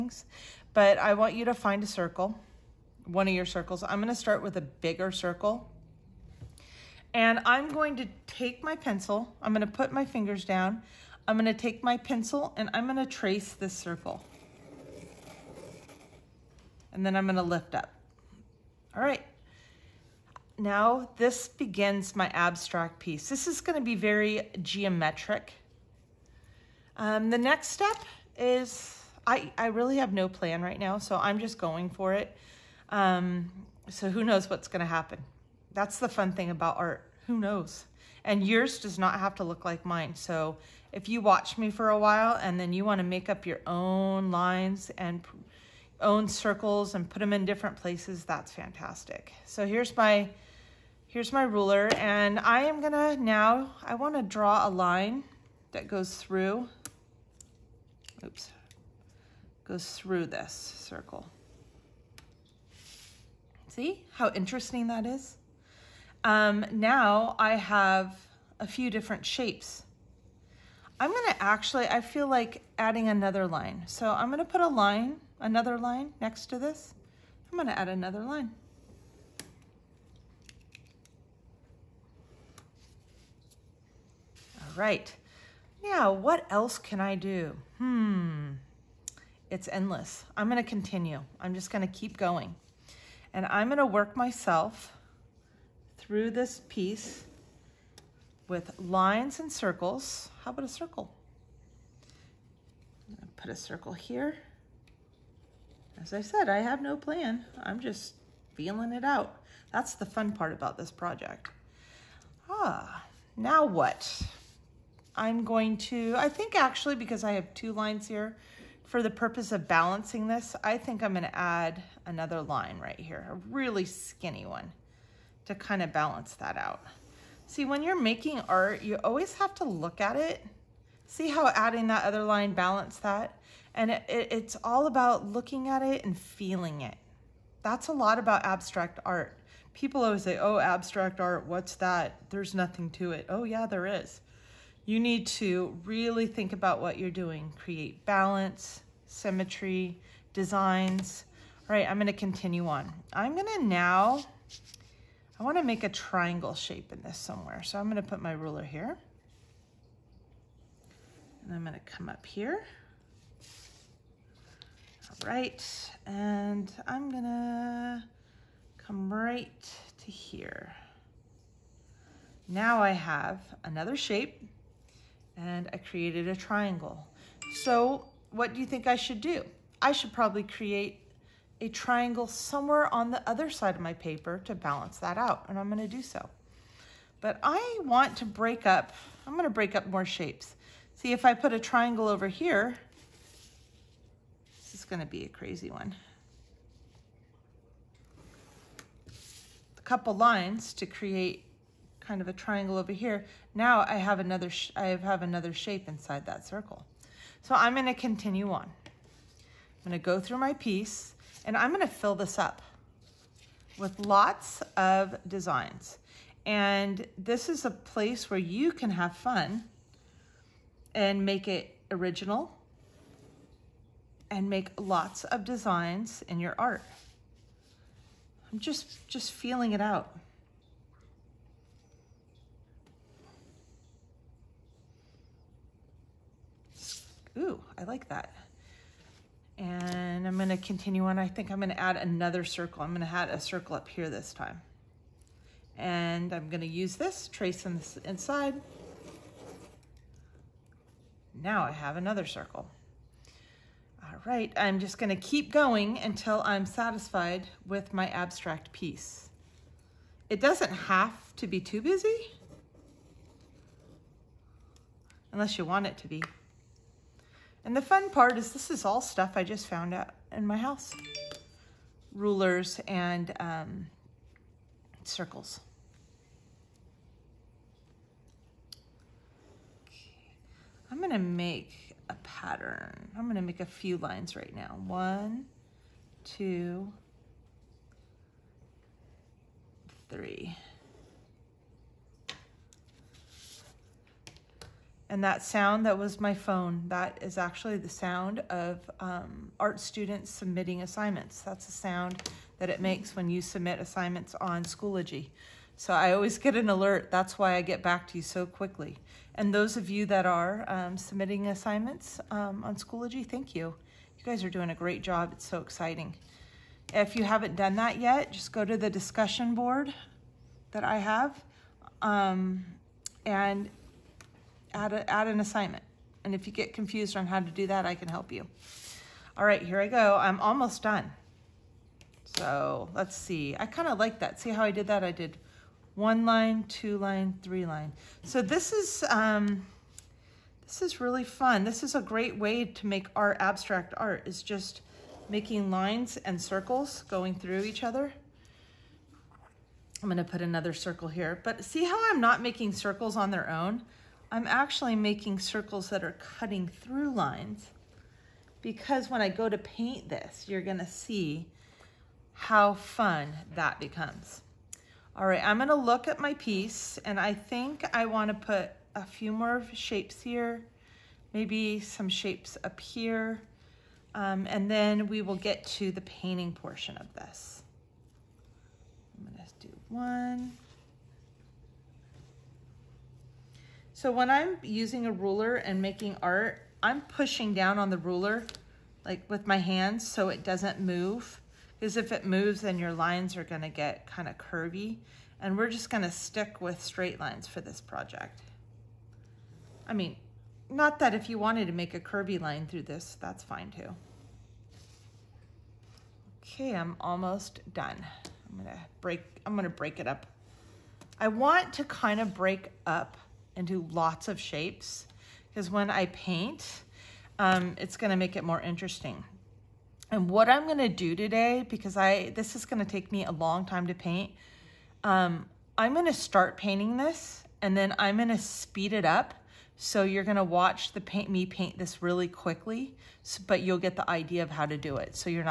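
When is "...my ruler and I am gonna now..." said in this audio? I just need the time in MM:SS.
00:51.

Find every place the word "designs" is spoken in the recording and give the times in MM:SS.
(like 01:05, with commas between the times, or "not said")
02:30, 03:35, 03:45.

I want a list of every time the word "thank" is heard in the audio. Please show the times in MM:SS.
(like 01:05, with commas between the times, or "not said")
05:13.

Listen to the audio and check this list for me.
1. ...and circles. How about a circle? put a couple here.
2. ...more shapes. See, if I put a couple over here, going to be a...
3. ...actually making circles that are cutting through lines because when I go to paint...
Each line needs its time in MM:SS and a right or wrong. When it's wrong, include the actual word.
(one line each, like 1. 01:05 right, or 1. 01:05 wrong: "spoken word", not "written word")
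1. 01:39 wrong: "circle", not "couple"
2. 03:09 wrong: "triangle", not "couple"
3. 05:54 right.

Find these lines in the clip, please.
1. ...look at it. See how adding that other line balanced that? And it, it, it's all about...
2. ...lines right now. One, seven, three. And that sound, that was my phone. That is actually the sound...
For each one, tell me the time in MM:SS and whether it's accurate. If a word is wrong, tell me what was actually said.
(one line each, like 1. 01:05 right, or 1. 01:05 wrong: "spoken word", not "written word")
1. 02:09 right
2. 04:43 wrong: "two", not "seven".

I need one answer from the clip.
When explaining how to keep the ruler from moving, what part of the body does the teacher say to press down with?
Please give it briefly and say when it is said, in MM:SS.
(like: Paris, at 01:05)
Hands, at 06:29.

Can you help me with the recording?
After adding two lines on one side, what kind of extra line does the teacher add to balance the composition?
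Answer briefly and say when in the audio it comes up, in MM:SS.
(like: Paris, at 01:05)
A really skinny one, at 02:03.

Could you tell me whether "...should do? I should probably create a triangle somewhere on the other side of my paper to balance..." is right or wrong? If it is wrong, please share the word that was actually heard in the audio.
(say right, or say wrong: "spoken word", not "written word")
right.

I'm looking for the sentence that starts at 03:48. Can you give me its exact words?
I'm just, just feeling it out.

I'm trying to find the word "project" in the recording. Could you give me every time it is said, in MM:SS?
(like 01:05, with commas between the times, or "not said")
01:50, 06:37.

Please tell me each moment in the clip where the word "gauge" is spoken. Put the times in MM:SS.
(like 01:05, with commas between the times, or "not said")
not said.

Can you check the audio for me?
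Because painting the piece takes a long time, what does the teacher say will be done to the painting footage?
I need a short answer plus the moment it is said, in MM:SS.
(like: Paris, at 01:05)
Speed it up, at 07:08.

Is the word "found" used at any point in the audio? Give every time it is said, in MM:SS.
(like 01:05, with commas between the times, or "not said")
04:29.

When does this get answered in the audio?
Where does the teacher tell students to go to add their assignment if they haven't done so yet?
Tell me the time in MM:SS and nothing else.
05:18.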